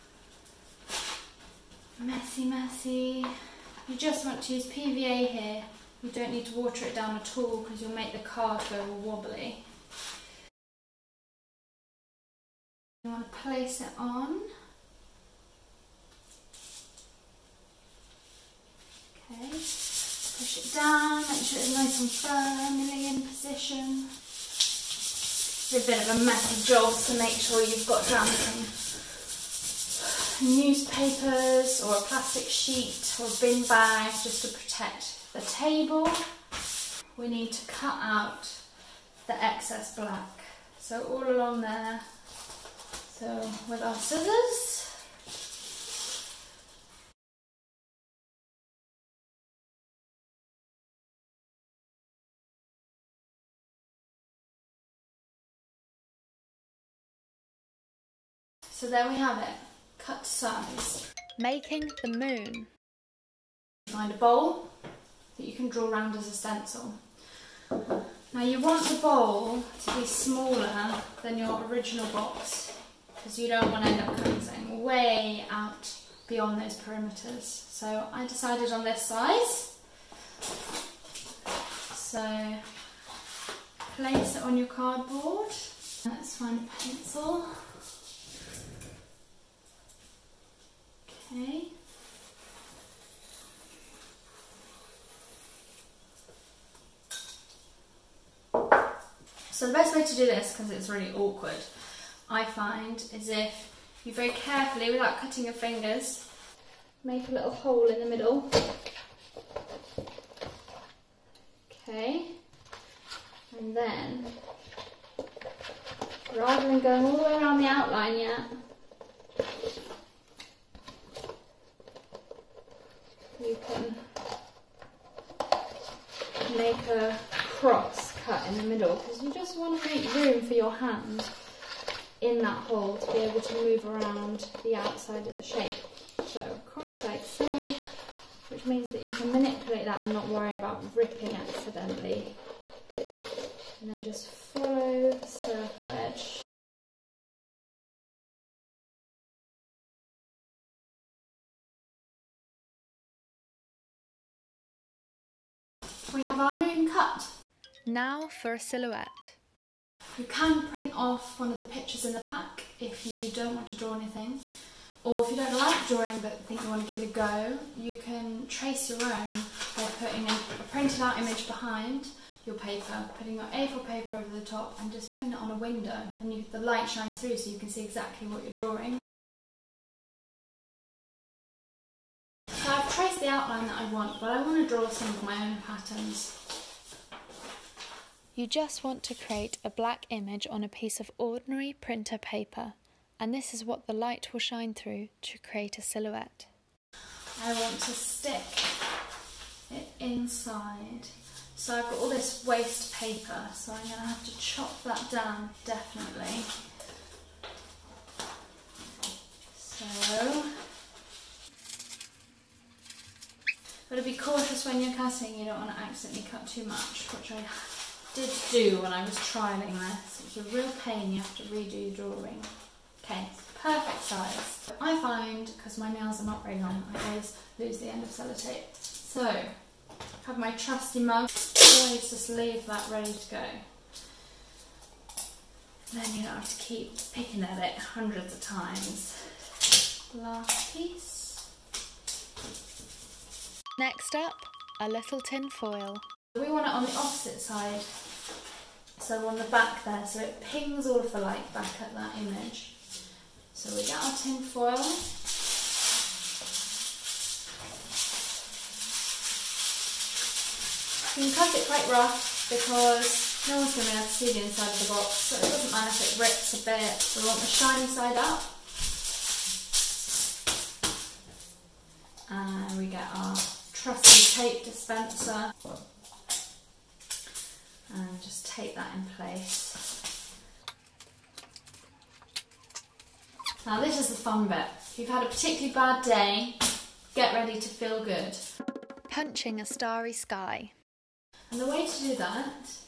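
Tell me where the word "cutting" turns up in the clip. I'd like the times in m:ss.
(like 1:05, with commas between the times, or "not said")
1:14, 1:45, 3:34.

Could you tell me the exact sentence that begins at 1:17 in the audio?
So I decided on this size.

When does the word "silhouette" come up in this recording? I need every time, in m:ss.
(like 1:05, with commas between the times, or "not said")
2:38, 3:15.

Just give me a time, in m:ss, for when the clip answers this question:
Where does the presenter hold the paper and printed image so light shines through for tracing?
2:55.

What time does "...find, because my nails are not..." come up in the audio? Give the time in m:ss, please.
3:45.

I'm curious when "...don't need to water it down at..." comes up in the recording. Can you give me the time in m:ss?
0:06.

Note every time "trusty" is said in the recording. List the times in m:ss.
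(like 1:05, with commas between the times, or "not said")
3:50, 4:33.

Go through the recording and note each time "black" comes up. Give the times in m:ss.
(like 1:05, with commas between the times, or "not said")
0:39, 3:09.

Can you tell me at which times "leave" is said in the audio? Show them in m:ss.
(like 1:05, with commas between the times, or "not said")
3:52.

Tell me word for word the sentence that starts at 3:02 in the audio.
So I've traced the outline that I want but I want to draw some of my own patterns.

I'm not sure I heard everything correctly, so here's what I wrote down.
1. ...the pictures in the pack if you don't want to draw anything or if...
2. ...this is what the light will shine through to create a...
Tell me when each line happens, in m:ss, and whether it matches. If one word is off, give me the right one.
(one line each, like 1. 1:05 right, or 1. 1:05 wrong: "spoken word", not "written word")
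1. 2:41 right
2. 3:13 right.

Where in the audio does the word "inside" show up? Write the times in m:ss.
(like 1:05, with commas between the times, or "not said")
3:20, 4:24.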